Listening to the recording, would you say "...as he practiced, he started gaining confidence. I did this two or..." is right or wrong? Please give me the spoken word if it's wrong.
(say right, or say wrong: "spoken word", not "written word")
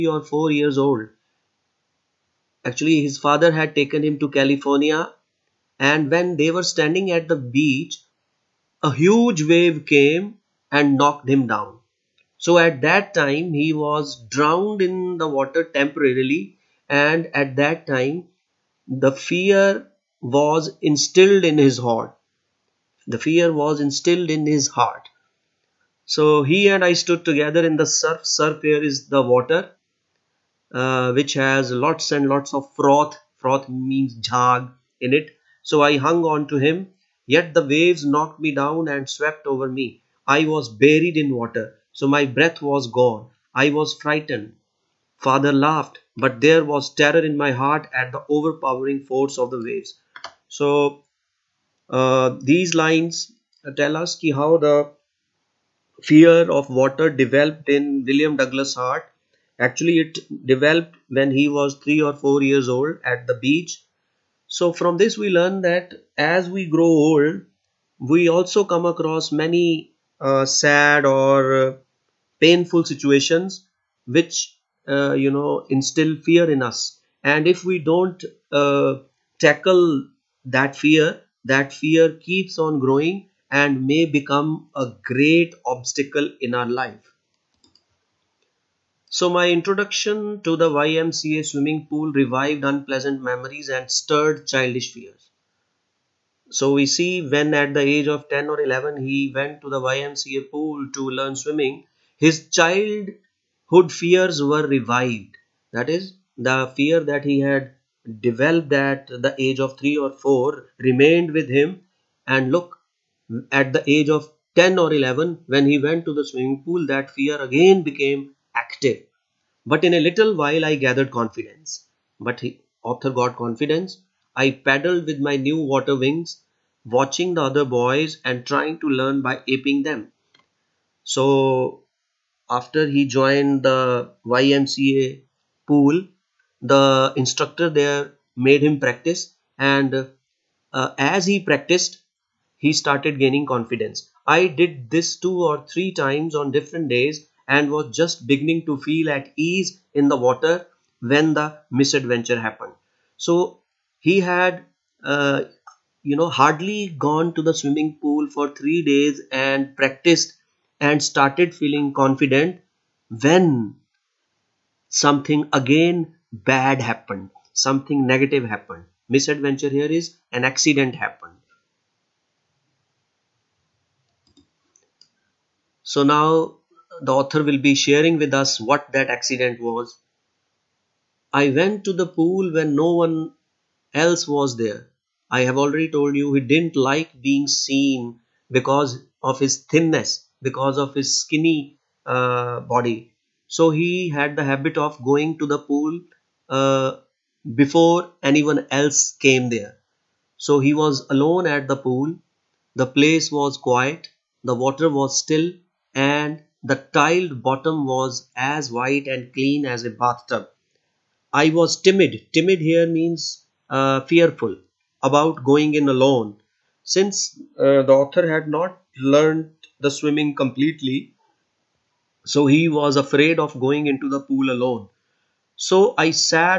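right.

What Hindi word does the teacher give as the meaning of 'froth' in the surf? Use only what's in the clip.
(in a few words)
jhag.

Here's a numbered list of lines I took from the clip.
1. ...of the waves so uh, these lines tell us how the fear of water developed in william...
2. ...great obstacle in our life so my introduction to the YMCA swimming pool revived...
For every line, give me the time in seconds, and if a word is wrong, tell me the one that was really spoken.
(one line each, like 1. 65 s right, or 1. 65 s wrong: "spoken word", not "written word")
1. 49 s right
2. 85 s right.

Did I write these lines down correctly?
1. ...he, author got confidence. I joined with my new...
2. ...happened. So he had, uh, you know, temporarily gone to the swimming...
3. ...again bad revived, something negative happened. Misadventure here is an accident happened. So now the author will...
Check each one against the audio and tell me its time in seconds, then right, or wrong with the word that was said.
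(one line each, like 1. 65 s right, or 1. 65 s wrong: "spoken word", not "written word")
1. 122 s wrong: "paddled", not "joined"
2. 152 s wrong: "hardly", not "temporarily"
3. 165 s wrong: "happened", not "revived".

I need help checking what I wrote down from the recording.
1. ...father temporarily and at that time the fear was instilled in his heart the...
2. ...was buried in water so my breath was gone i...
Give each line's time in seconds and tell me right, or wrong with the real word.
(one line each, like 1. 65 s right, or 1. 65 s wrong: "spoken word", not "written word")
1. 15 s wrong: "water", not "father"
2. 40 s right.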